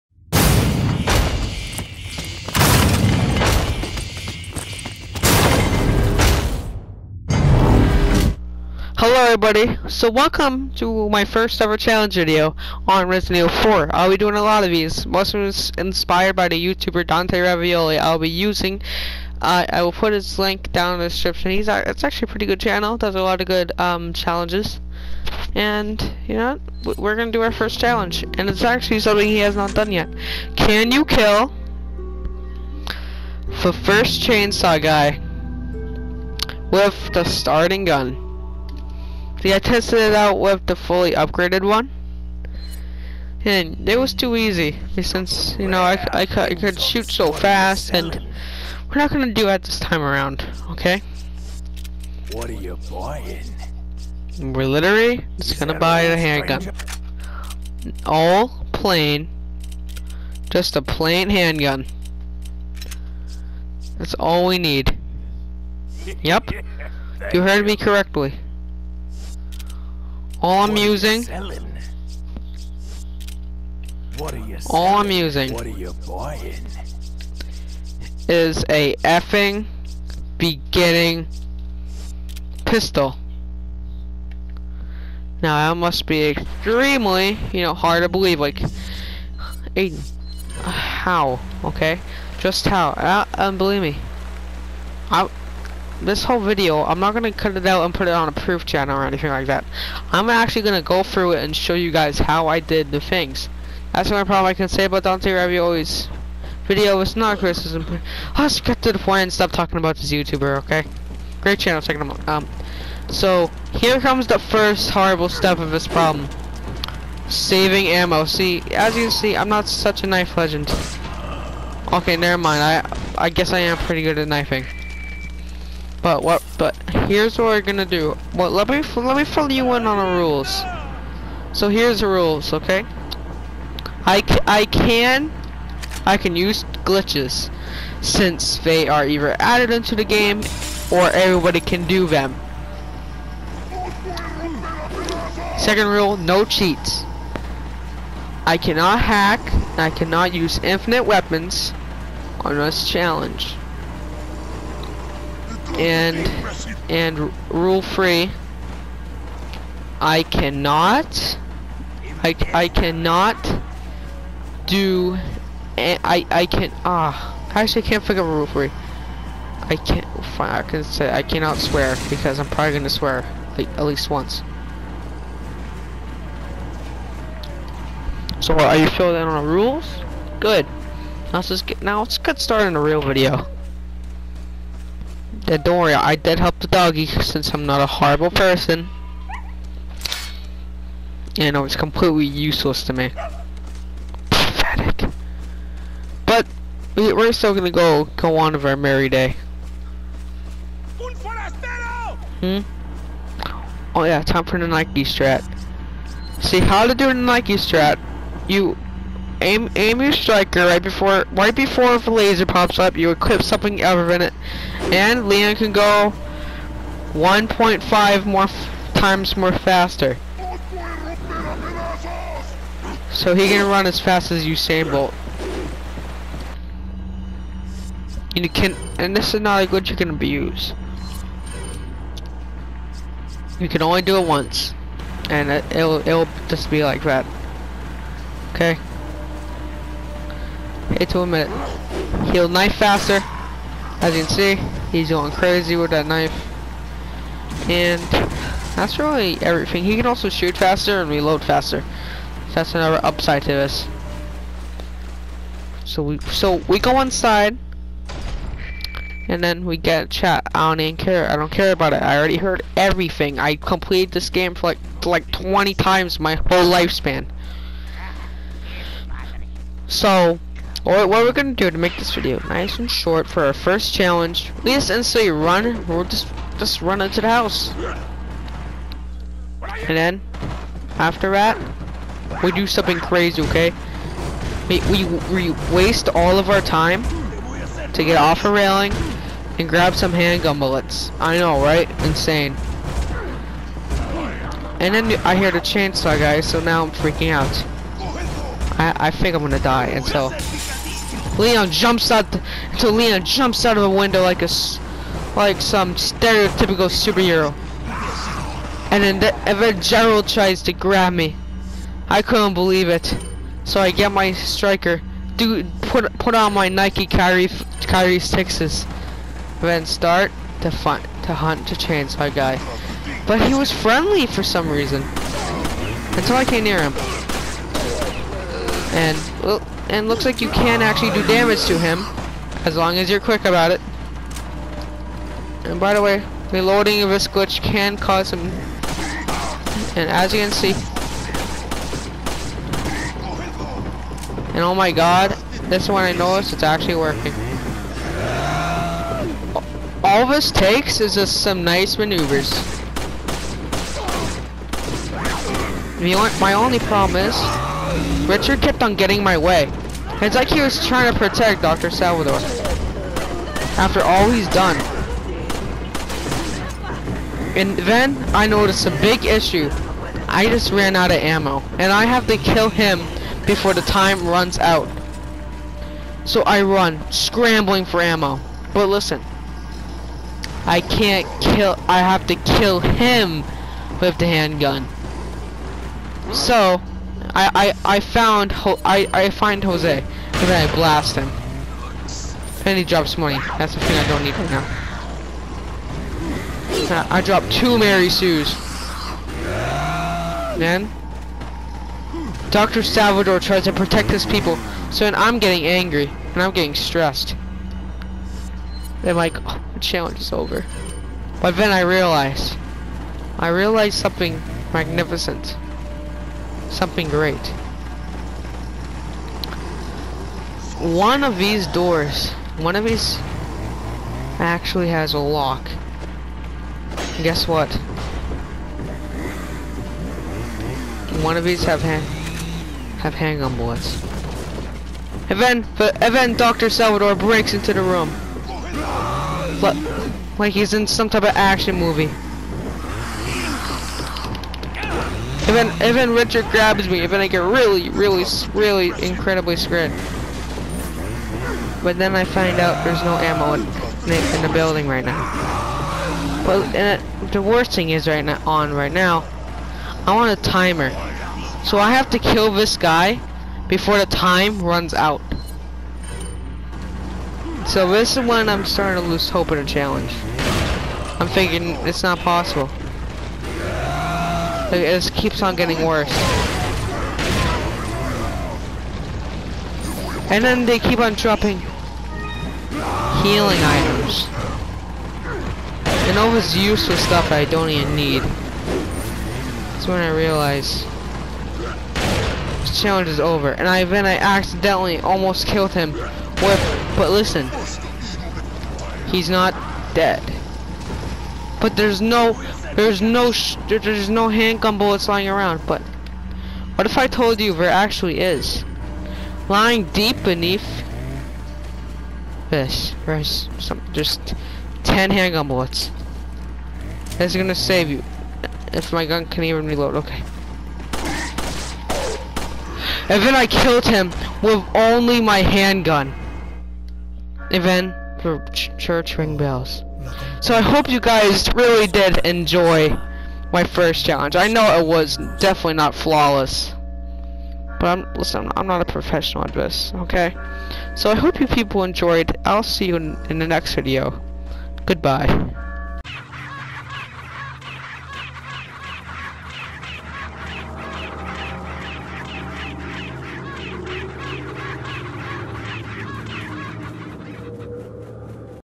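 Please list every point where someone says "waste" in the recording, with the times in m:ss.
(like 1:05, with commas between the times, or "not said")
4:45.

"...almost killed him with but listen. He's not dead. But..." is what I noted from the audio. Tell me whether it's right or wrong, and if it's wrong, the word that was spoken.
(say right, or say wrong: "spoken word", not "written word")
right.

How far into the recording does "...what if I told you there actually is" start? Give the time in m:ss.
8:26.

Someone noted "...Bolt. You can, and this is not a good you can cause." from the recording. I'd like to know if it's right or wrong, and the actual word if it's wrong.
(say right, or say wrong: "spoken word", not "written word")
wrong: "abuse", not "cause".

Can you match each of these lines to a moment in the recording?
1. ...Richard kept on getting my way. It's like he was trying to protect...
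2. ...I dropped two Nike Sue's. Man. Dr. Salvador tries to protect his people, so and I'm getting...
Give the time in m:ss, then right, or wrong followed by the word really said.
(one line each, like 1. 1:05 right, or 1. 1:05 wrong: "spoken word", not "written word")
1. 5:58 right
2. 6:37 wrong: "Mary", not "Nike".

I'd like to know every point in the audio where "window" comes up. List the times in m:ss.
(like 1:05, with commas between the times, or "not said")
5:03.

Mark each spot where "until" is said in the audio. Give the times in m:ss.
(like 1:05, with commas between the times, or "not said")
5:02, 5:26.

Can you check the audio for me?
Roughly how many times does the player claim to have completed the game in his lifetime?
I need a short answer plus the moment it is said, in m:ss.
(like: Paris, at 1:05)
20, at 4:25.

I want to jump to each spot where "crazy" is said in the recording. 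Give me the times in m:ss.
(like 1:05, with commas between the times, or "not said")
4:05, 4:42.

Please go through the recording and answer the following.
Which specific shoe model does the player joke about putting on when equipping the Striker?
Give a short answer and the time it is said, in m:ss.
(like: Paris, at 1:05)
Kyrie sixes, at 5:17.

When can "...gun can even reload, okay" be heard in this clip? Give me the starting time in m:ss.
8:39.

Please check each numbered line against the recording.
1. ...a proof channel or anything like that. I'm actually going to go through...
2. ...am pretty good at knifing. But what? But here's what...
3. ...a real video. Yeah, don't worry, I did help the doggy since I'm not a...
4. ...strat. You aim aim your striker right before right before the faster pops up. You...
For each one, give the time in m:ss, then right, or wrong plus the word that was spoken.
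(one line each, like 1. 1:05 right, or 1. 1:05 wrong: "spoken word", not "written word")
1. 1:38 right
2. 2:03 right
3. 3:02 right
4. 3:27 wrong: "laser", not "faster".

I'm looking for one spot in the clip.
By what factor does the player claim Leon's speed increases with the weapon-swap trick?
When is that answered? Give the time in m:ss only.
3:37.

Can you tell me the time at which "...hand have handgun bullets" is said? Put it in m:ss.
7:11.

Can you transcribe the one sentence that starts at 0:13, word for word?
I'll be doing a lot of these.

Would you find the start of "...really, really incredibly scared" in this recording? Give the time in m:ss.
7:27.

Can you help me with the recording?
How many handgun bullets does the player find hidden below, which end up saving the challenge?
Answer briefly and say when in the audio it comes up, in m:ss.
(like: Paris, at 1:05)
10, at 8:34.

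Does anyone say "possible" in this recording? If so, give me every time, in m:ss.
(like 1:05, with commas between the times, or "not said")
7:52.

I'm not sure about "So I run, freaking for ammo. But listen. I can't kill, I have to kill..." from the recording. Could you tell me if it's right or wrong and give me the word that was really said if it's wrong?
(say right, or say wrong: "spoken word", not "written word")
wrong: "scrambling", not "freaking".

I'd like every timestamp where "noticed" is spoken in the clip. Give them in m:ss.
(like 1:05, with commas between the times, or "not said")
5:46, 6:08.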